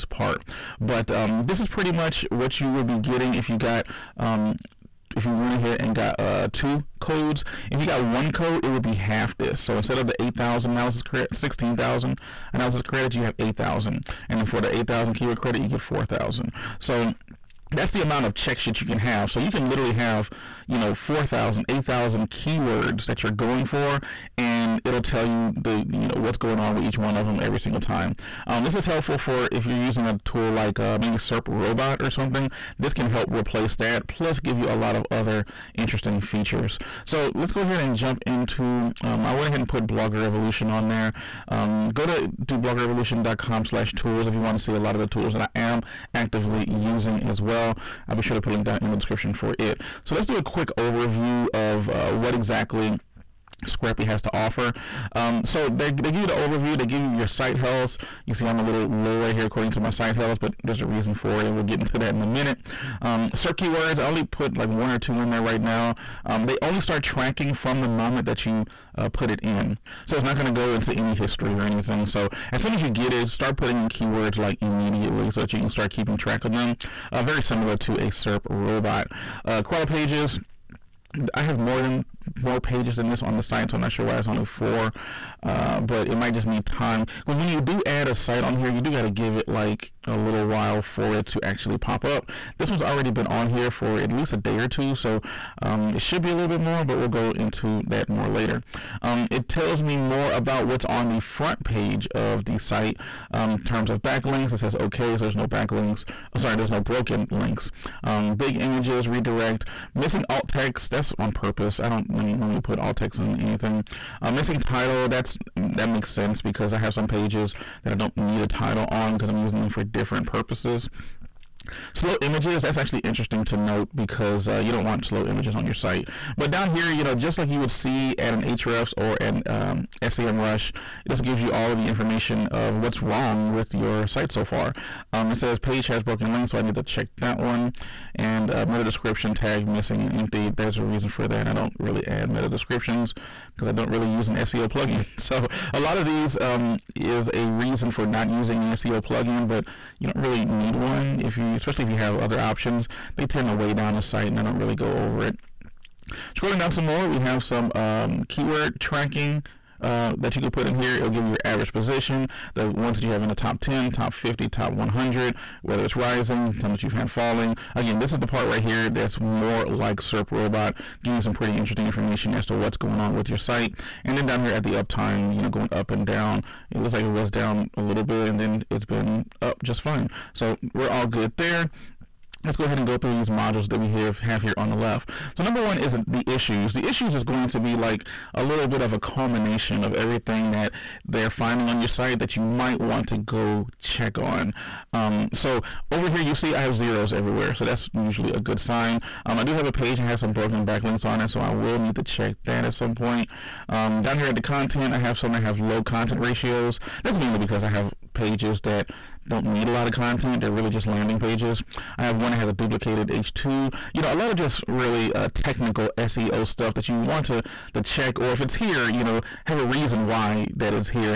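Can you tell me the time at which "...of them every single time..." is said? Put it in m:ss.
0:27.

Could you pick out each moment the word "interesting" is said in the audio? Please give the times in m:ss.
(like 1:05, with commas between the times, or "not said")
0:35, 2:02, 2:51.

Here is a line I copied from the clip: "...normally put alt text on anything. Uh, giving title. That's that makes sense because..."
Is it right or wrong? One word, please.
wrong.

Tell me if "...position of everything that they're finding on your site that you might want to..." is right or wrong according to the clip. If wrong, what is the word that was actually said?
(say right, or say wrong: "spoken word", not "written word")
wrong: "culmination", not "position".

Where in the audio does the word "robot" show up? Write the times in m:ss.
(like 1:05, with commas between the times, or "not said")
0:31, 1:18, 2:50.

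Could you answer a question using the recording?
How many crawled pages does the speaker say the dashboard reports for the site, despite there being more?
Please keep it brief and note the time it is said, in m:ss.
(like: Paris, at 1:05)
4, at 1:24.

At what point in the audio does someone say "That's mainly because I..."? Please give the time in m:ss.
3:27.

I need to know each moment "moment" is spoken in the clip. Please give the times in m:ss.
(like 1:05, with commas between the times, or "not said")
1:07.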